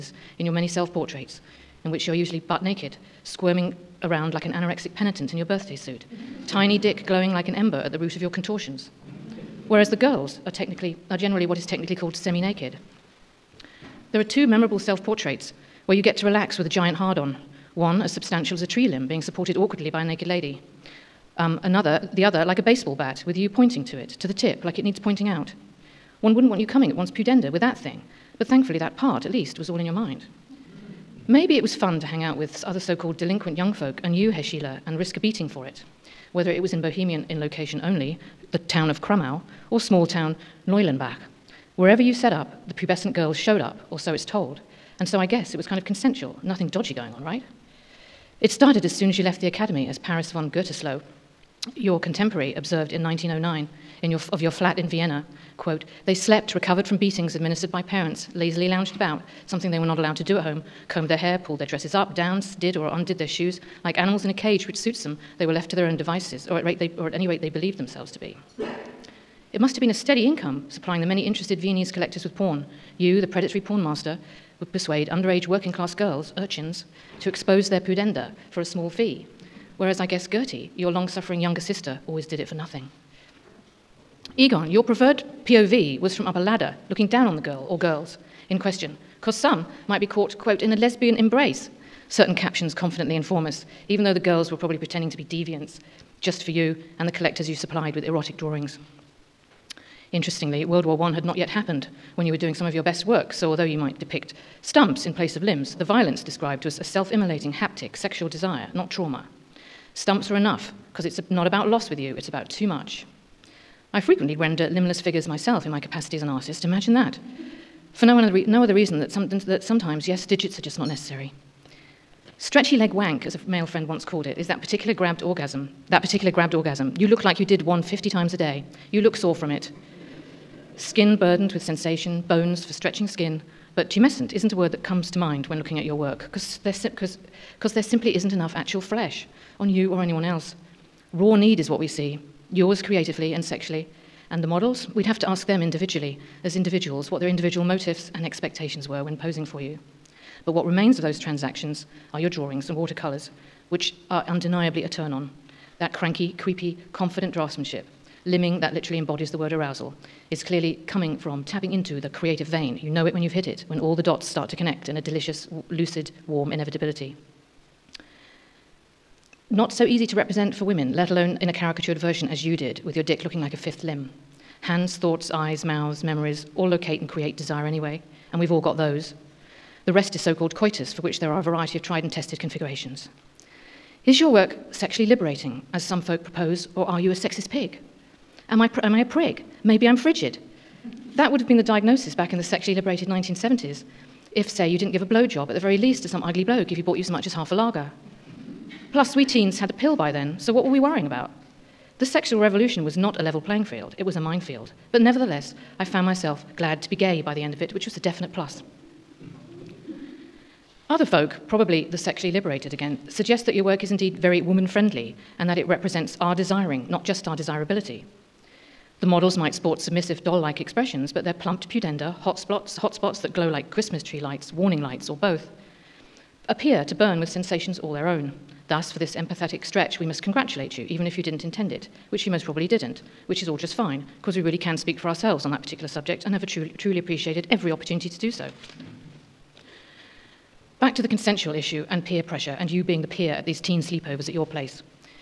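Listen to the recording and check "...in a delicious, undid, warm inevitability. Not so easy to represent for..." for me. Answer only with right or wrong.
wrong.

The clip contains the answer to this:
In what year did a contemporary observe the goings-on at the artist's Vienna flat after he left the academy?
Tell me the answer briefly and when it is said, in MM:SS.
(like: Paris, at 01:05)
1909, at 00:53.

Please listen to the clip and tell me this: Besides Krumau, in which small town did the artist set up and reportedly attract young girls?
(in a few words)
Neulenbach.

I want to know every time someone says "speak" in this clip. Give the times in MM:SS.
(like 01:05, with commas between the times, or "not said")
03:54.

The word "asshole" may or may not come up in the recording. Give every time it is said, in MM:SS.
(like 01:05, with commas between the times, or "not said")
not said.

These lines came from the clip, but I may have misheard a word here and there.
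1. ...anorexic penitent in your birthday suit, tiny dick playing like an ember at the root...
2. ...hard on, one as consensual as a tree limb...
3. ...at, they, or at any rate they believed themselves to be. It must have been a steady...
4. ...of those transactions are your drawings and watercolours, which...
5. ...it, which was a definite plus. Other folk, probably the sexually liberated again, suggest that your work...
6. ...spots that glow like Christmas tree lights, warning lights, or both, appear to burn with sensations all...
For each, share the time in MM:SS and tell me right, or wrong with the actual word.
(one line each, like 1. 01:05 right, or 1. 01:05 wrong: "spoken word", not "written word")
1. 00:04 wrong: "glowing", not "playing"
2. 00:16 wrong: "substantial", not "consensual"
3. 01:06 right
4. 02:30 right
5. 03:27 right
6. 03:42 right.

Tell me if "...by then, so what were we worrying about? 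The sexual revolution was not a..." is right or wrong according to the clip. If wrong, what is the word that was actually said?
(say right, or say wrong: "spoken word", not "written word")
right.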